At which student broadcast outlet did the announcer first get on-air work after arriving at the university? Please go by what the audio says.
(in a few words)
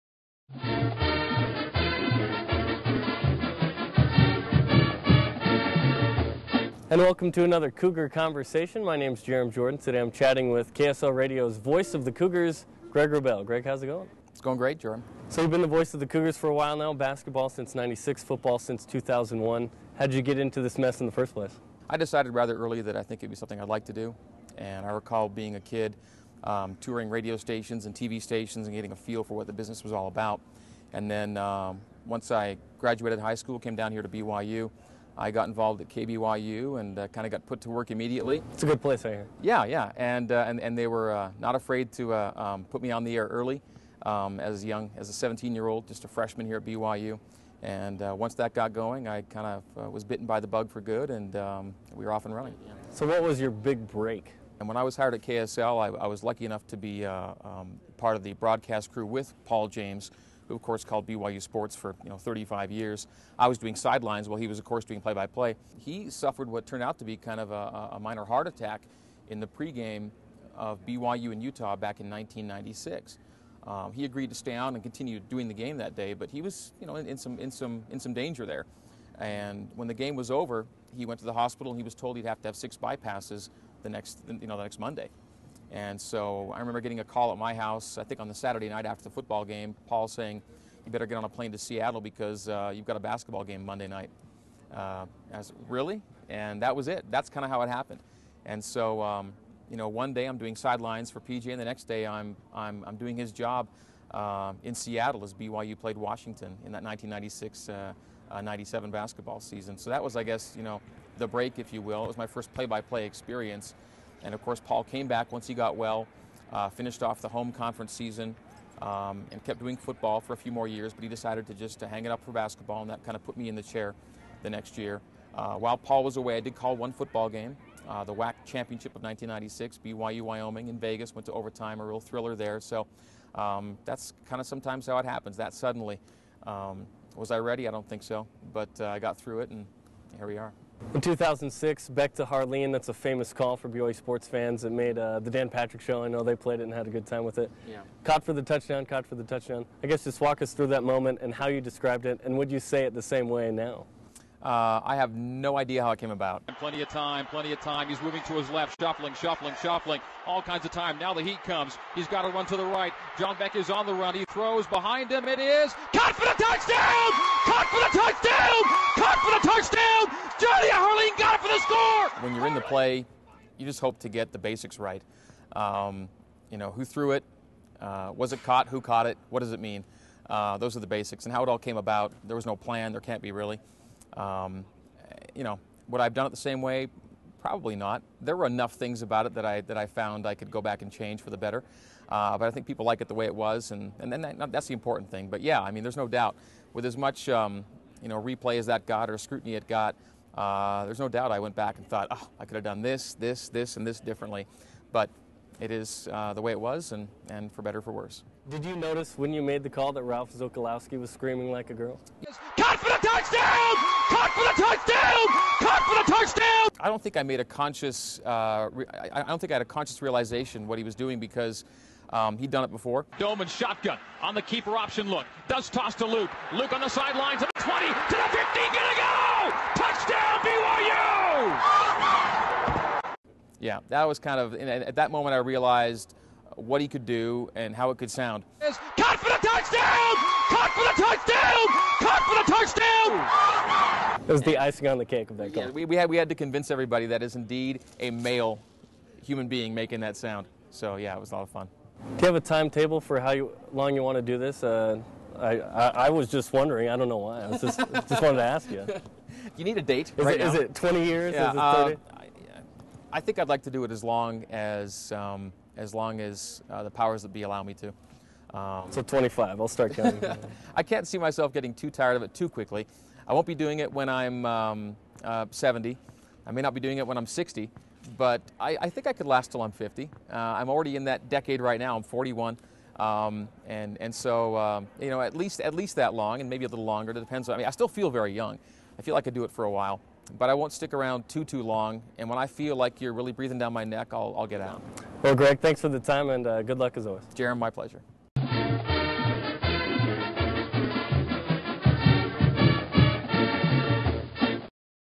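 KBYU.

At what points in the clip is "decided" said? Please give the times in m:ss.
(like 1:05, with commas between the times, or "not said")
0:21, 2:01.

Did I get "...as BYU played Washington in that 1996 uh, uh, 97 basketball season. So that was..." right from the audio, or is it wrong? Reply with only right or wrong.
right.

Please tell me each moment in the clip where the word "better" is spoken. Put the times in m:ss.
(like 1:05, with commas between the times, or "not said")
1:30, 3:11, 3:27.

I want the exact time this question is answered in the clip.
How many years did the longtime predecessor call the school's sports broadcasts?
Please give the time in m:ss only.
1:02.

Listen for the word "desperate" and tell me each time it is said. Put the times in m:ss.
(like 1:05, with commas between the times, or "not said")
not said.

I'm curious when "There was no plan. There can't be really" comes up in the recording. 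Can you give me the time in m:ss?
3:02.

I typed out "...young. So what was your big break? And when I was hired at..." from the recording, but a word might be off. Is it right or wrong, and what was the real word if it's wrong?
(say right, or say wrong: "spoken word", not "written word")
wrong: "running", not "young".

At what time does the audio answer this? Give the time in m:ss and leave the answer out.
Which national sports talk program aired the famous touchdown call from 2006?
2:25.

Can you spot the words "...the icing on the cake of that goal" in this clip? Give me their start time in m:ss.
4:04.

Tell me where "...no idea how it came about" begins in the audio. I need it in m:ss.
2:35.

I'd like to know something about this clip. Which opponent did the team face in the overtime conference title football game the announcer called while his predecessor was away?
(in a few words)
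Wyoming.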